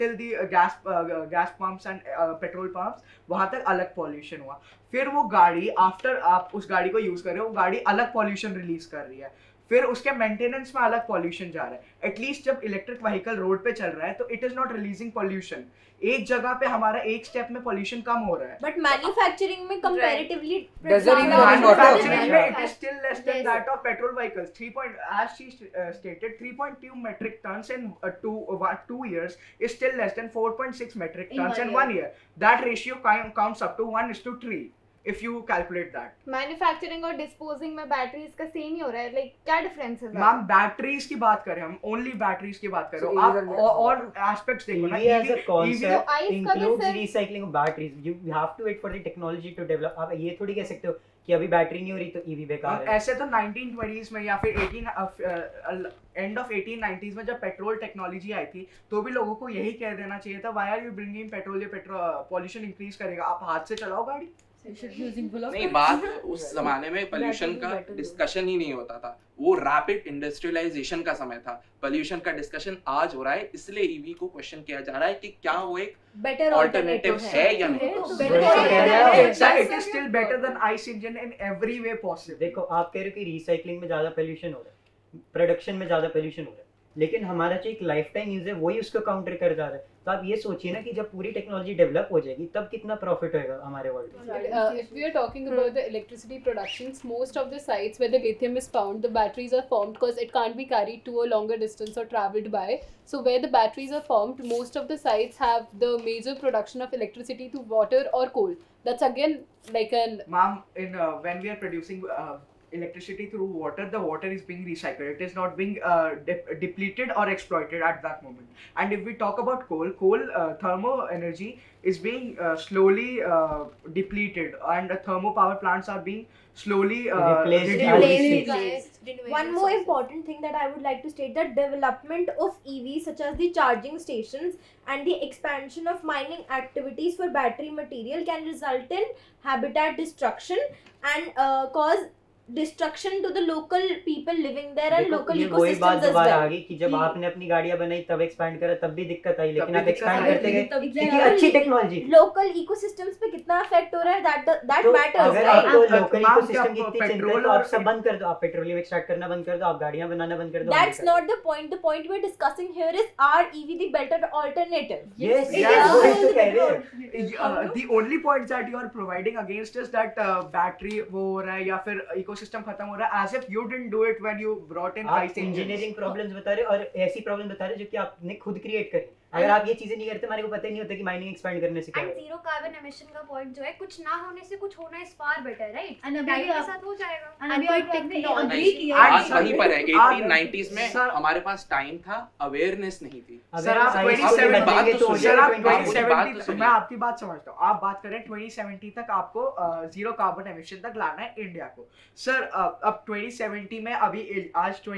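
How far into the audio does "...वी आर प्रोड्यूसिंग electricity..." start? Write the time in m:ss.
1:51.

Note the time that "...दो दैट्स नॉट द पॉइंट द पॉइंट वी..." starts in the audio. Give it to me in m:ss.
2:40.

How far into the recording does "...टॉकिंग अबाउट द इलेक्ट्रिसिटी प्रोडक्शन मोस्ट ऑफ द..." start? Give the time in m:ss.
1:35.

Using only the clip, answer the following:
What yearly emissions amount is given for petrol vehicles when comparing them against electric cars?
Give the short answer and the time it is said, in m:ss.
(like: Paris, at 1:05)
4.6 metric tons, at 0:30.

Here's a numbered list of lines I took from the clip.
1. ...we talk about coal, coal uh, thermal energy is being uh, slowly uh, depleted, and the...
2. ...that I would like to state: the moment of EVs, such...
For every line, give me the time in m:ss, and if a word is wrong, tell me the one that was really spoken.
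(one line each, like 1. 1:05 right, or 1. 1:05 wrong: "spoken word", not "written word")
1. 1:59 right
2. 2:10 wrong: "development", not "moment".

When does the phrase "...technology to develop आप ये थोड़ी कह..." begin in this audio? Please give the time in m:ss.
0:49.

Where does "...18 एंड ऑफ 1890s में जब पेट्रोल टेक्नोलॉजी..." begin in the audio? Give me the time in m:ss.
0:54.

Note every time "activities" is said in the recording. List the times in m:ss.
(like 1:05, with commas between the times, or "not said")
2:16.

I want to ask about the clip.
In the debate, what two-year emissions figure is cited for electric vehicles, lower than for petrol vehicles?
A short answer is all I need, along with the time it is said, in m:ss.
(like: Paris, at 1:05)
3.2 metric tons, at 0:26.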